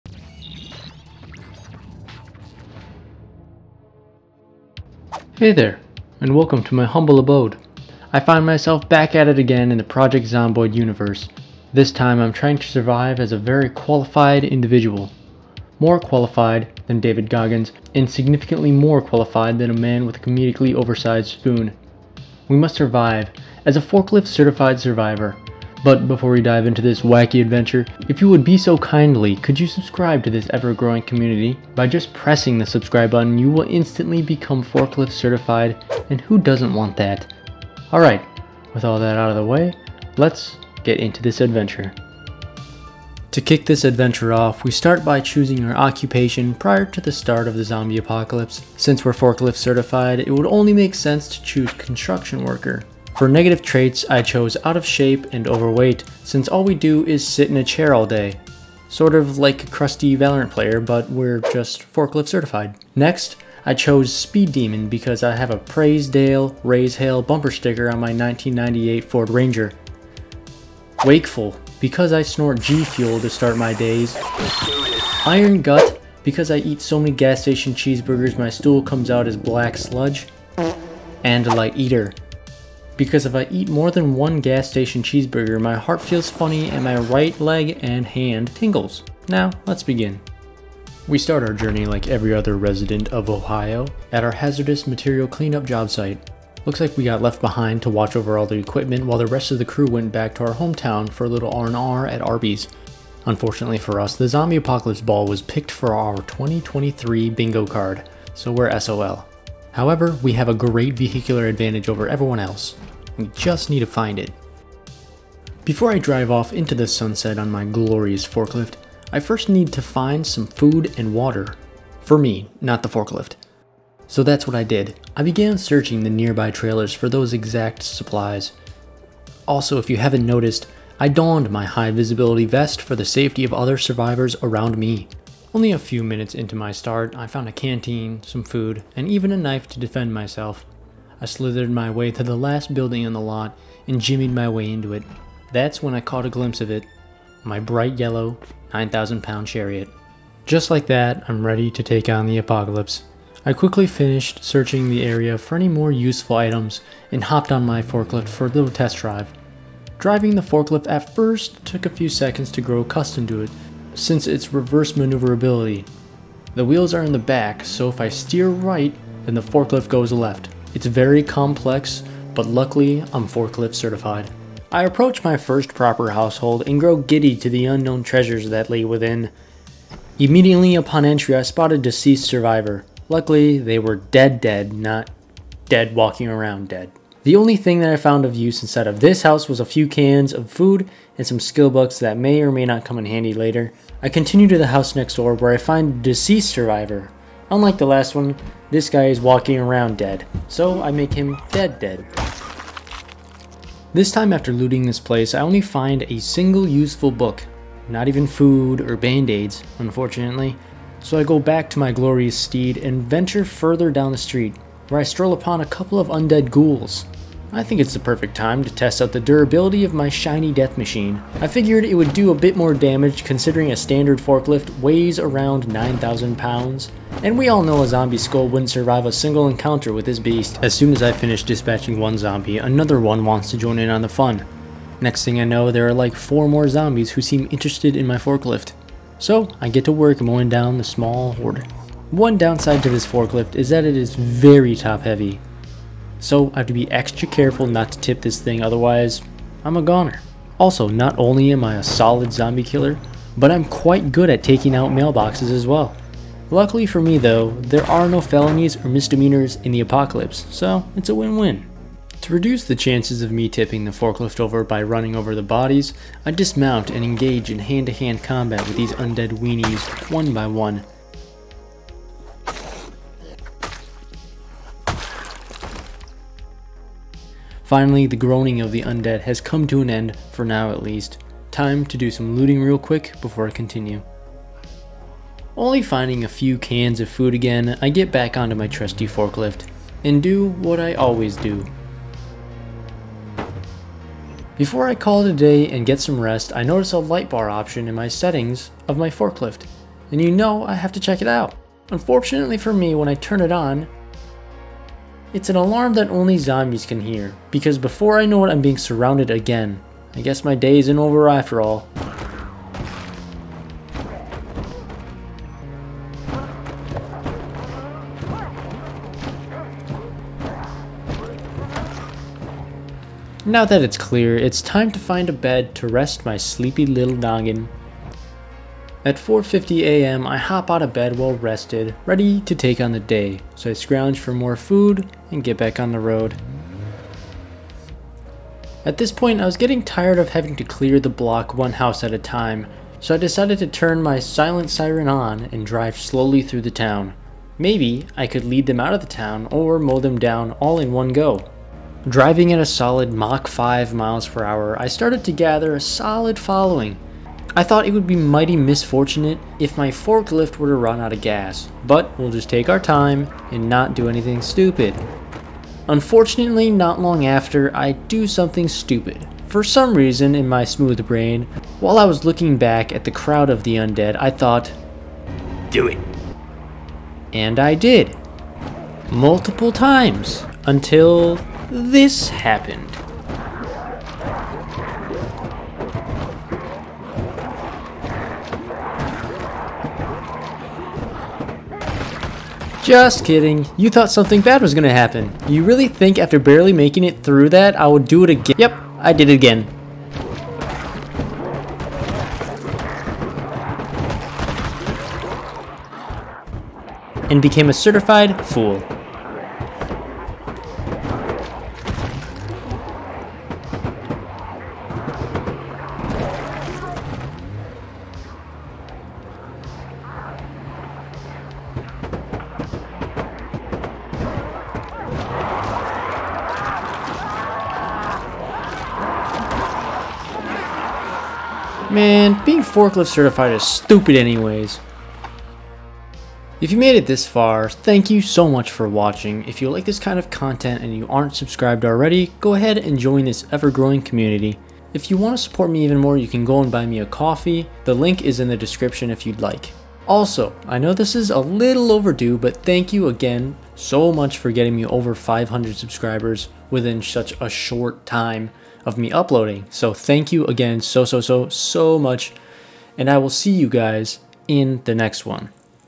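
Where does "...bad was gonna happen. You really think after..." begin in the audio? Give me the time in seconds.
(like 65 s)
394 s.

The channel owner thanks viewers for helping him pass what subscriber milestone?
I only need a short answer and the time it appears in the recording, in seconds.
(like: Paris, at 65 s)
500 subscribers, at 455 s.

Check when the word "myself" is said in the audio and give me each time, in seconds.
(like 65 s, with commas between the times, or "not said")
8 s, 140 s.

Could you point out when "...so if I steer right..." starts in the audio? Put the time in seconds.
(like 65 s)
167 s.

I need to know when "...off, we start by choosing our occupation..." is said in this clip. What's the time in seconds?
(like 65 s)
44 s.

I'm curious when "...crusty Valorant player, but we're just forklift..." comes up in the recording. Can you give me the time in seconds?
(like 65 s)
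59 s.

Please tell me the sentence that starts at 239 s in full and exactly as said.
So, I get to work mowing down the small horde.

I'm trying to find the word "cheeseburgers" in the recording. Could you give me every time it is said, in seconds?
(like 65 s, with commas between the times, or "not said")
77 s, 85 s.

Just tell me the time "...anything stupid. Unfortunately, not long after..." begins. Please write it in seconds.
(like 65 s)
364 s.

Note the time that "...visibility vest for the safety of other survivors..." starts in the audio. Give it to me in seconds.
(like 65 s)
131 s.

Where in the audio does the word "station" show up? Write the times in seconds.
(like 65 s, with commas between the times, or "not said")
77 s, 84 s.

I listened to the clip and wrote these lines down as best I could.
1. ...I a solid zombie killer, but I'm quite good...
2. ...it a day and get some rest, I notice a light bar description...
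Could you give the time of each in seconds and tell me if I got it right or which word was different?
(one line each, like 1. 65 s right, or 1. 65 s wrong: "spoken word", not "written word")
1. 251 s right
2. 295 s wrong: "option", not "description".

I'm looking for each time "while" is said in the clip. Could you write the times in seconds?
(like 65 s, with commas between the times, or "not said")
99 s, 371 s.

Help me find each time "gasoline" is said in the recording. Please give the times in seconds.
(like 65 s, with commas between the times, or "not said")
not said.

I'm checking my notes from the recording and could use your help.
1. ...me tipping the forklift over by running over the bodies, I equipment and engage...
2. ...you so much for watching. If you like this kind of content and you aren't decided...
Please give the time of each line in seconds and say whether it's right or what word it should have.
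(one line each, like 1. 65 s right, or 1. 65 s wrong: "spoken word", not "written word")
1. 263 s wrong: "dismount", not "equipment"
2. 438 s wrong: "subscribed", not "decided".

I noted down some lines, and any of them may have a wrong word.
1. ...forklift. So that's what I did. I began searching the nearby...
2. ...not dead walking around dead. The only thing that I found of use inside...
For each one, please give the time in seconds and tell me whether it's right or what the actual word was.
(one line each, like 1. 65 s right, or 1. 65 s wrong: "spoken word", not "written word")
1. 122 s right
2. 184 s right.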